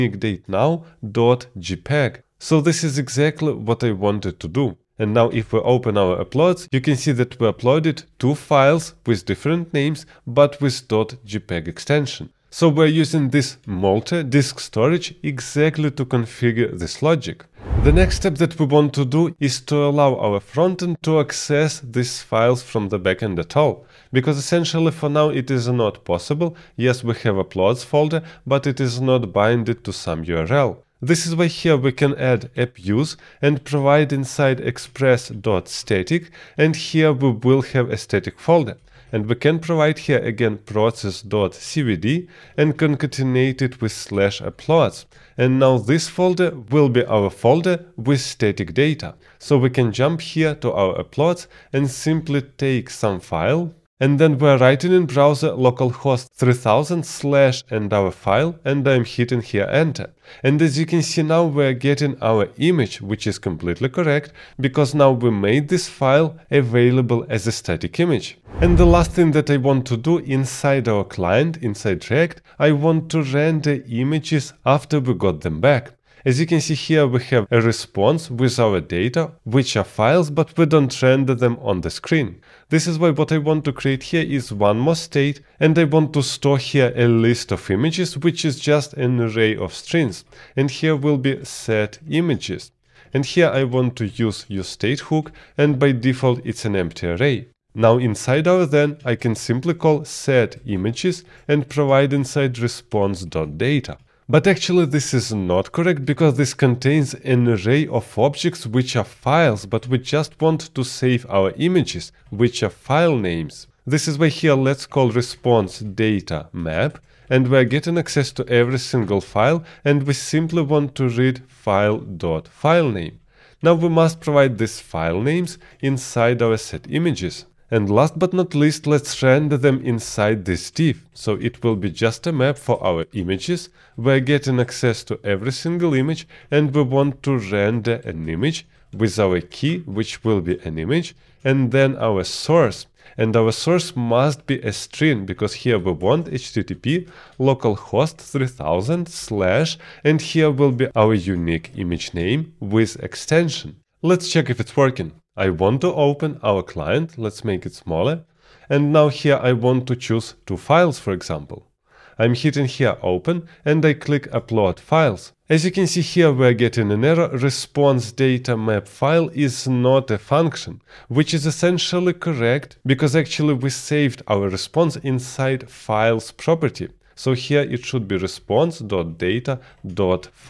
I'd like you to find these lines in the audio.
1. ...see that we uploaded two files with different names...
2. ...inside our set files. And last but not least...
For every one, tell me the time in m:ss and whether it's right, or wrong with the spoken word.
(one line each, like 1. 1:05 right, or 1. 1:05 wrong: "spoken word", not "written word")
1. 0:06 right
2. 2:05 wrong: "images", not "files".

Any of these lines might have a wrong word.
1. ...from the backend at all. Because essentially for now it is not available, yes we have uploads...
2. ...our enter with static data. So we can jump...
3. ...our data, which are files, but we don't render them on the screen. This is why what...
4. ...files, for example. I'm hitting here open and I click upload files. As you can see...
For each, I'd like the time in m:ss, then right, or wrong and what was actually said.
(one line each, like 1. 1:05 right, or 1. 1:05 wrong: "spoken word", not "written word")
1. 0:22 wrong: "possible", not "available"
2. 0:47 wrong: "folder", not "enter"
3. 1:18 right
4. 2:40 right.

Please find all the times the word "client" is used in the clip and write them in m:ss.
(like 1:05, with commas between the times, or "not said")
1:11, 2:36.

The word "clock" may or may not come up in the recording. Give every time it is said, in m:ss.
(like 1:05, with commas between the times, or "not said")
not said.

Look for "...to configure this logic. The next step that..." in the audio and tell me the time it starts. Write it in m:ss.
0:15.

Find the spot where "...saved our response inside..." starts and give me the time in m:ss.
2:53.